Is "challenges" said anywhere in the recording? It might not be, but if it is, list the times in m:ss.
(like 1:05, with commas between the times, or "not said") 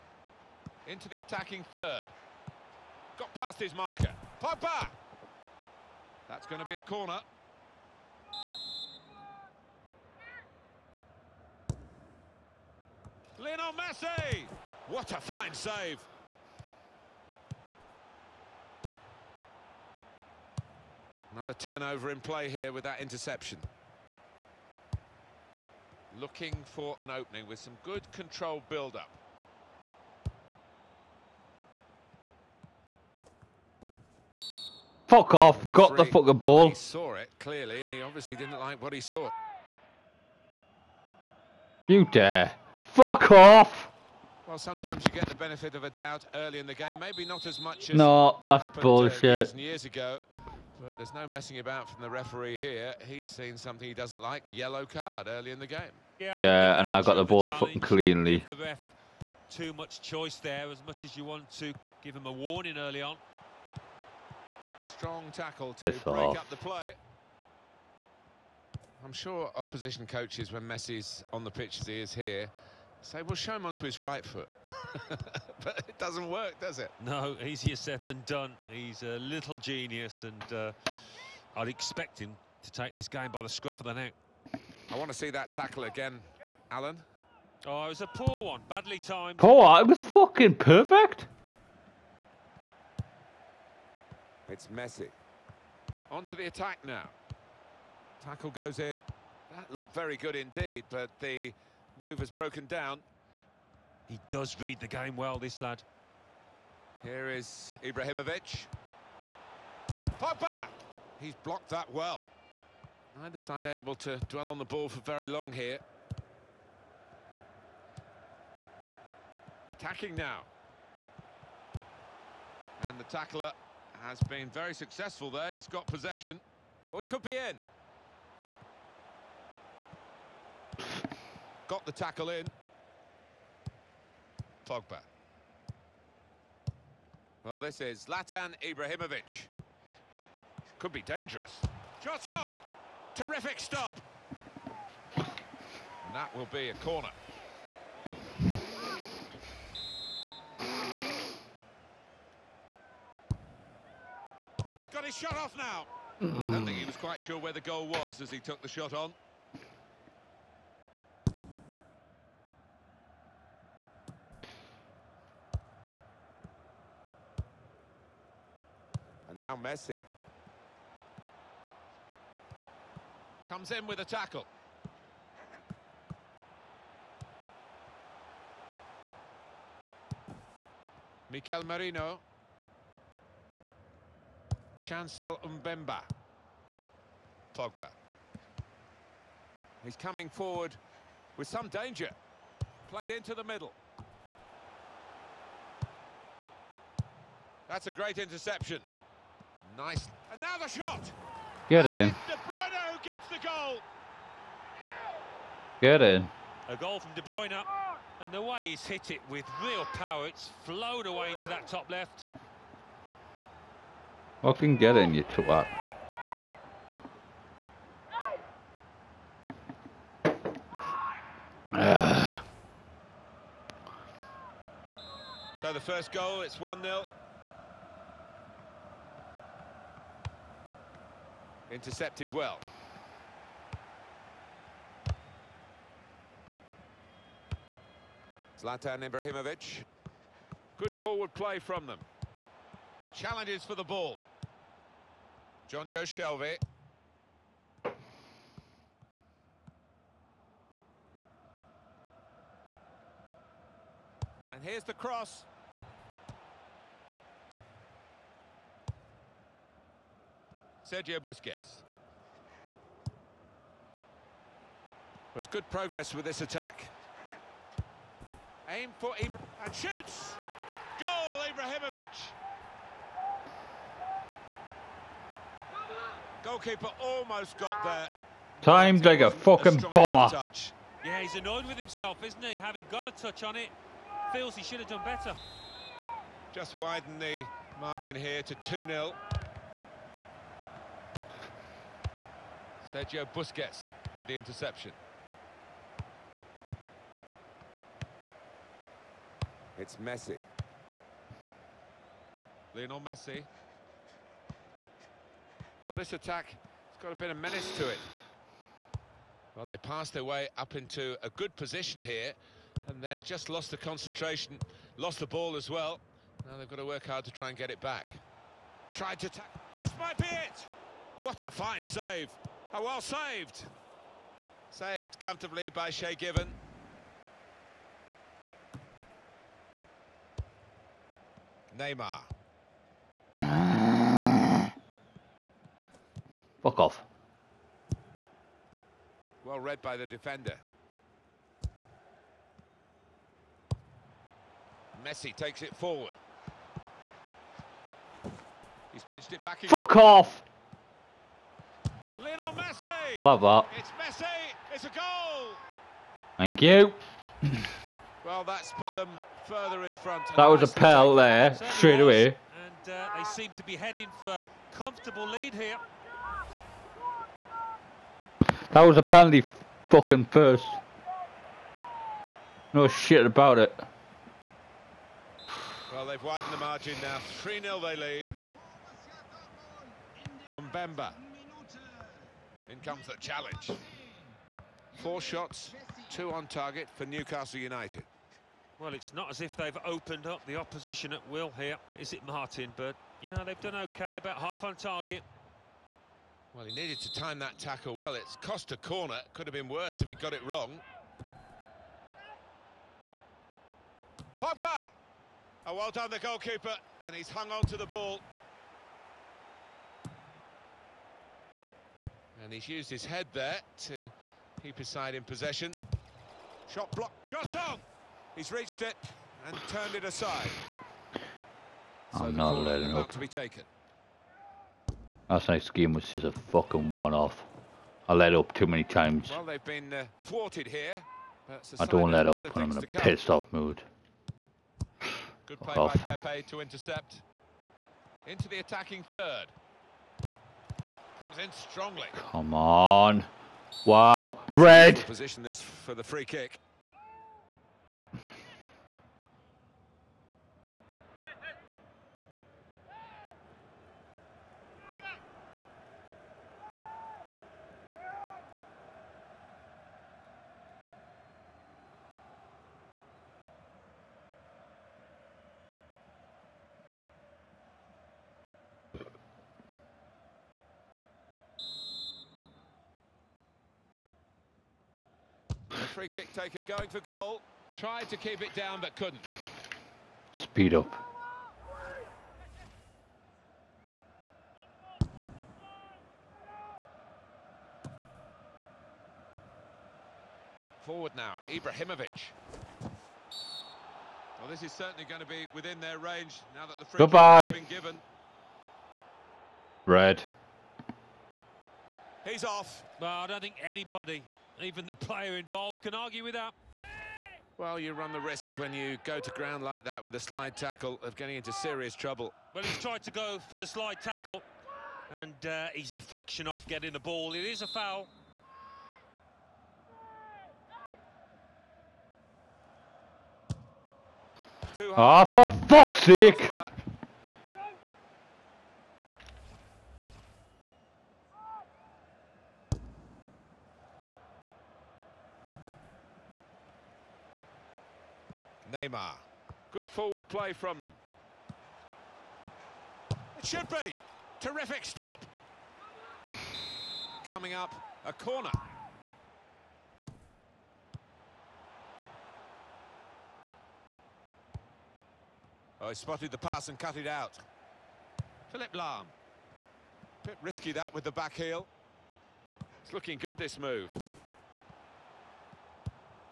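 4:03, 6:23.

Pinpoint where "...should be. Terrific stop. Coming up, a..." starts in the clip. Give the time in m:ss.
9:03.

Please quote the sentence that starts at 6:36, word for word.
Well, he needed to time that tackle well.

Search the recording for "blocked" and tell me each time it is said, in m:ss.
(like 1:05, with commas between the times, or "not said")
1:51, 6:56.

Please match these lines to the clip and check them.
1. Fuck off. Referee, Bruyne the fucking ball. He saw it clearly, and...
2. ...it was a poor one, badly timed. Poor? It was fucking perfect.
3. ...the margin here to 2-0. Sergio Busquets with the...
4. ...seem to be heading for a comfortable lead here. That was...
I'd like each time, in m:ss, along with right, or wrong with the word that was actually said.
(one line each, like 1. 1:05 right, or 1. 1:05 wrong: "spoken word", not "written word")
1. 0:35 wrong: "Got", not "Bruyne"
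2. 1:27 right
3. 4:47 right
4. 6:03 right.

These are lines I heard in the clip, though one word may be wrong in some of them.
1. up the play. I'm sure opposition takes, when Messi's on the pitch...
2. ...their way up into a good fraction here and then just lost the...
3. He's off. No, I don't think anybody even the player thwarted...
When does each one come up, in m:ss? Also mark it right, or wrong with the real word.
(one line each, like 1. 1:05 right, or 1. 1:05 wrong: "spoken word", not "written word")
1. 1:06 wrong: "coaches", not "takes"
2. 5:10 wrong: "position", not "fraction"
3. 8:22 wrong: "involved", not "thwarted".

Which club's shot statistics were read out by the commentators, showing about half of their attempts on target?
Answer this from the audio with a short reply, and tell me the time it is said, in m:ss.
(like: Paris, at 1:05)
Newcastle United, at 6:27.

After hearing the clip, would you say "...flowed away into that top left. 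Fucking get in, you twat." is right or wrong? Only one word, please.
right.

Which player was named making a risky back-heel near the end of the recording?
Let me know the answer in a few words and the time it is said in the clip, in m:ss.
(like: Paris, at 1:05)
Philipp Lahm, at 9:18.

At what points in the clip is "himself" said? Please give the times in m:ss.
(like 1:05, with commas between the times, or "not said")
4:41.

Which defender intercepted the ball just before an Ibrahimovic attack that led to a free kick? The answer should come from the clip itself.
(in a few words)
Pepe.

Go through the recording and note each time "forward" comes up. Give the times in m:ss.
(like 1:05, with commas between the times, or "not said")
3:10, 4:00, 5:45, 8:10, 8:59.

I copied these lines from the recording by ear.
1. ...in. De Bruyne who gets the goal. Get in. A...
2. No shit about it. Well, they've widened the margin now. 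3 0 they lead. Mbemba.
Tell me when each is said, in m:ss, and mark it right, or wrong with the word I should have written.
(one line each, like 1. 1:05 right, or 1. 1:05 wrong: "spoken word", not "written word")
1. 3:21 right
2. 6:12 right.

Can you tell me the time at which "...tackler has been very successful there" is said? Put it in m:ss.
2:03.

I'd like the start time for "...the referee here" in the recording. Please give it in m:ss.
0:52.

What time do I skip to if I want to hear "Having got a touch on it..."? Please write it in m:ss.
4:42.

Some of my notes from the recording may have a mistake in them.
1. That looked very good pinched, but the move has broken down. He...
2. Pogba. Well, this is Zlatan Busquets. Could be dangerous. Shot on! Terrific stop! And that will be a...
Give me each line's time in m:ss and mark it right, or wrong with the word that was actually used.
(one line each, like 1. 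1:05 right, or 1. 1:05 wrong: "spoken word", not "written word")
1. 1:39 wrong: "indeed", not "pinched"
2. 2:14 wrong: "Ibrahimovic", not "Busquets".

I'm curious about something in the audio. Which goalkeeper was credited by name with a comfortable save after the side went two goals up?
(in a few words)
Shay Given.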